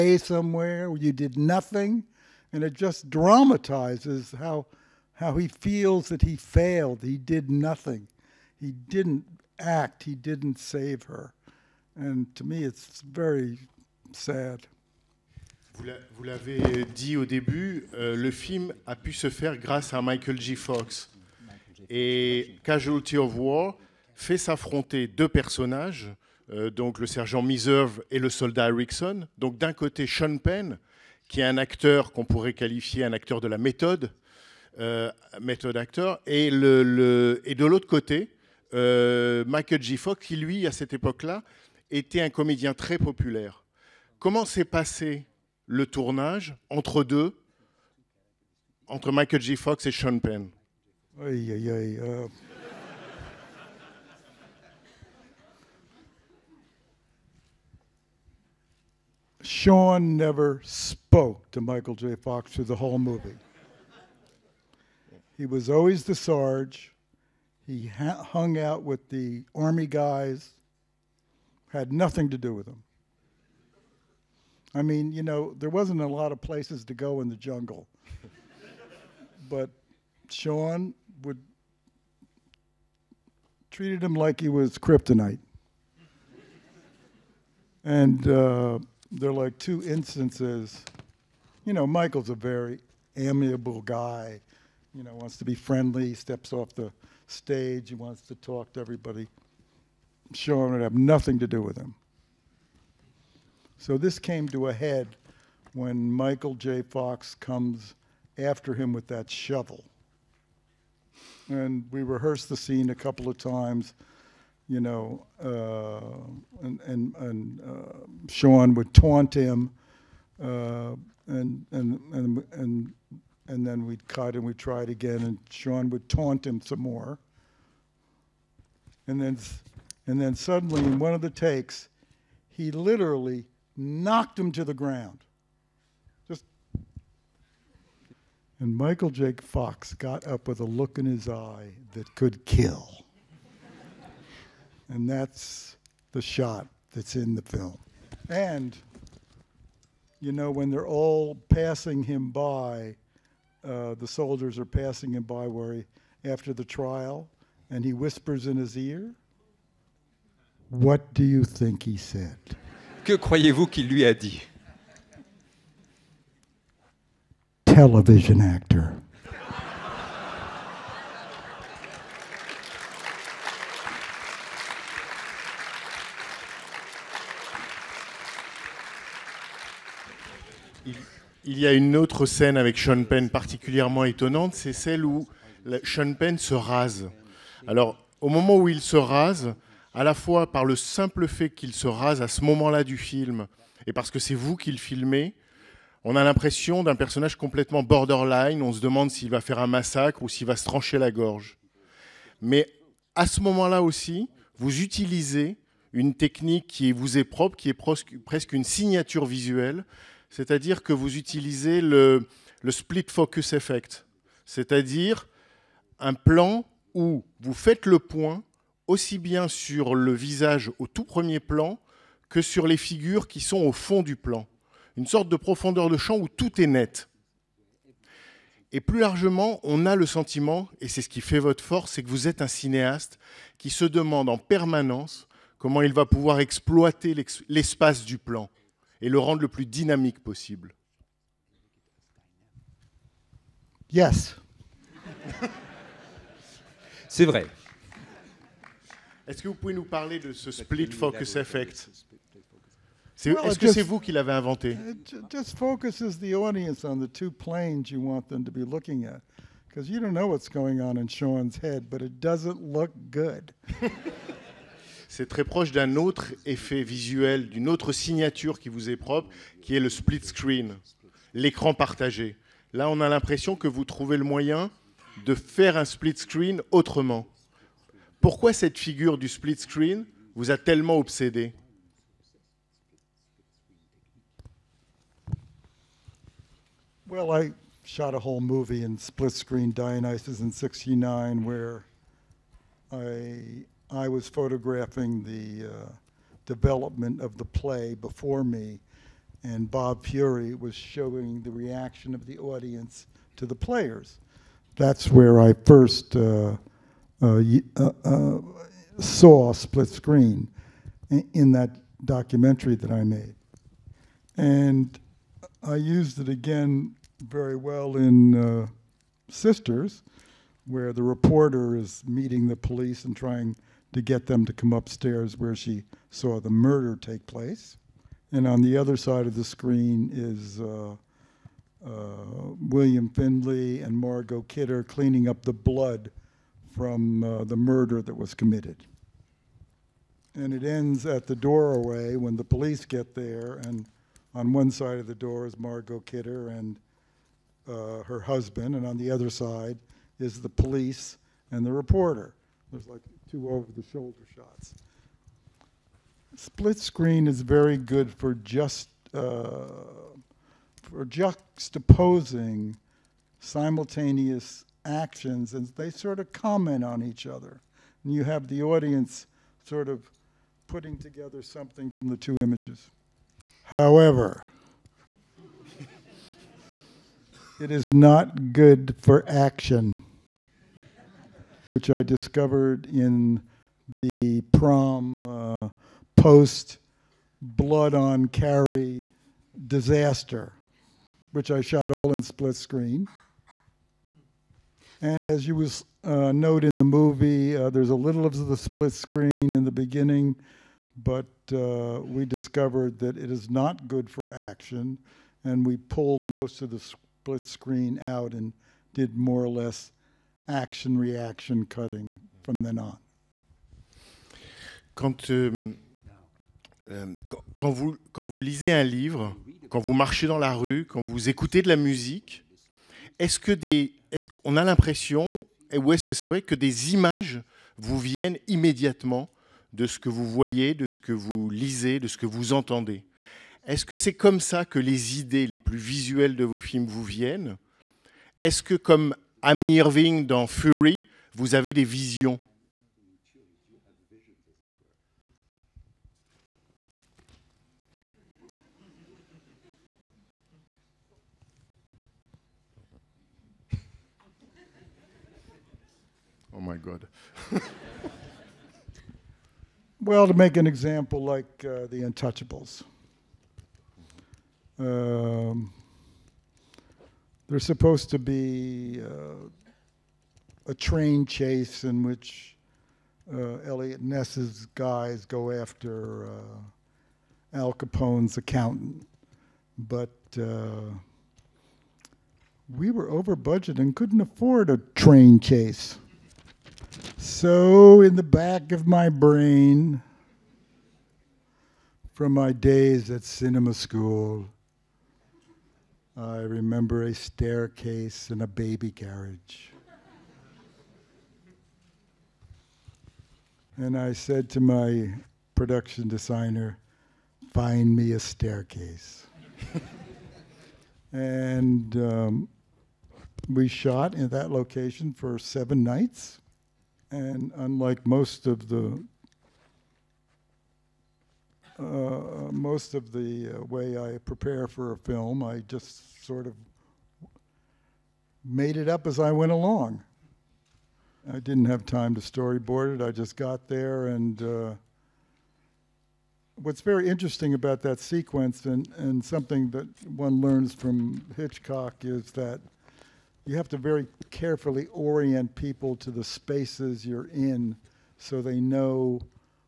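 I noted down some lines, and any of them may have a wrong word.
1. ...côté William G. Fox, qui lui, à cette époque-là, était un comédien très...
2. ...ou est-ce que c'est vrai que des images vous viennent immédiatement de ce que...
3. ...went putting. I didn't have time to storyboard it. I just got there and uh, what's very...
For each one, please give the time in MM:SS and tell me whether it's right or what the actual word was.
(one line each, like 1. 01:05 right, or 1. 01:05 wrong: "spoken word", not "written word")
1. 00:37 wrong: "Michael", not "William"
2. 07:05 right
3. 08:49 wrong: "along", not "putting".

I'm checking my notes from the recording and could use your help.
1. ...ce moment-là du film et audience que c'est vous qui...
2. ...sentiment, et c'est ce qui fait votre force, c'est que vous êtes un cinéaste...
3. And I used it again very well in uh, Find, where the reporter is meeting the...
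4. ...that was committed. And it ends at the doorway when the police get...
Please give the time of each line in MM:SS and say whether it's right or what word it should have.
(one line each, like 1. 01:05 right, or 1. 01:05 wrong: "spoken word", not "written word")
1. 03:12 wrong: "parce", not "audience"
2. 03:50 right
3. 05:14 wrong: "Sisters", not "Find"
4. 05:38 right.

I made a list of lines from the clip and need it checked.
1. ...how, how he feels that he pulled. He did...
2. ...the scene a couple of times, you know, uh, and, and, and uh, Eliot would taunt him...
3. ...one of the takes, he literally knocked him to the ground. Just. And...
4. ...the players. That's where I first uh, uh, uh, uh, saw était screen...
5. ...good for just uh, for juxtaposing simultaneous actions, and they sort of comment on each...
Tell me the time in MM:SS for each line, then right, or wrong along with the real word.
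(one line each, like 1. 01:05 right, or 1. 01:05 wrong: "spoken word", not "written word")
1. 00:04 wrong: "failed", not "pulled"
2. 01:52 wrong: "Sean", not "Eliot"
3. 02:10 right
4. 05:03 wrong: "split", not "était"
5. 05:57 right.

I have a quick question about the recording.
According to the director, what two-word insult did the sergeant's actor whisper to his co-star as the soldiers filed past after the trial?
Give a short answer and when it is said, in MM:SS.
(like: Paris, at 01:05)
Television actor, at 02:47.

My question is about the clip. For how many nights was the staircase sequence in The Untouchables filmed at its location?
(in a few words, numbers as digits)
7.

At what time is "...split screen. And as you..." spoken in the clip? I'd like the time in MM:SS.
06:32.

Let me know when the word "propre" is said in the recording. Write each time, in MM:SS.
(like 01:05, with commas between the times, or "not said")
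03:27, 04:28.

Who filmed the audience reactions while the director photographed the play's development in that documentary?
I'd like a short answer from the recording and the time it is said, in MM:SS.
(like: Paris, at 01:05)
Bob Fiore, at 04:59.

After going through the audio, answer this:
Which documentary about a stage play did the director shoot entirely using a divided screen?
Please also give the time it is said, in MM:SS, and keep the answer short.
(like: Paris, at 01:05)
Dionysus in 69, at 04:49.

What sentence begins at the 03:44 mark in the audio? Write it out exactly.
Une sorte de profondeur de champ où tout est net.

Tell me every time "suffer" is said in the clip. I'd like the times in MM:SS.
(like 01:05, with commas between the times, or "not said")
not said.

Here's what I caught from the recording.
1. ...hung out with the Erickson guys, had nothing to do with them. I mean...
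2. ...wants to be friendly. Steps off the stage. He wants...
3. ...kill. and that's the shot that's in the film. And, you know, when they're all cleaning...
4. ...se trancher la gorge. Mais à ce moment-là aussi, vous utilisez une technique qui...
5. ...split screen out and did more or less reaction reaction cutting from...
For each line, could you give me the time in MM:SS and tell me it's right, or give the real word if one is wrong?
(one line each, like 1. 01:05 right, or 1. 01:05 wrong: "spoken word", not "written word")
1. 01:07 wrong: "Army", not "Erickson"
2. 01:35 right
3. 02:22 wrong: "passing", not "cleaning"
4. 03:20 right
5. 06:46 wrong: "action", not "reaction".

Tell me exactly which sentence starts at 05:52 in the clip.
There's like two over the shoulder shots.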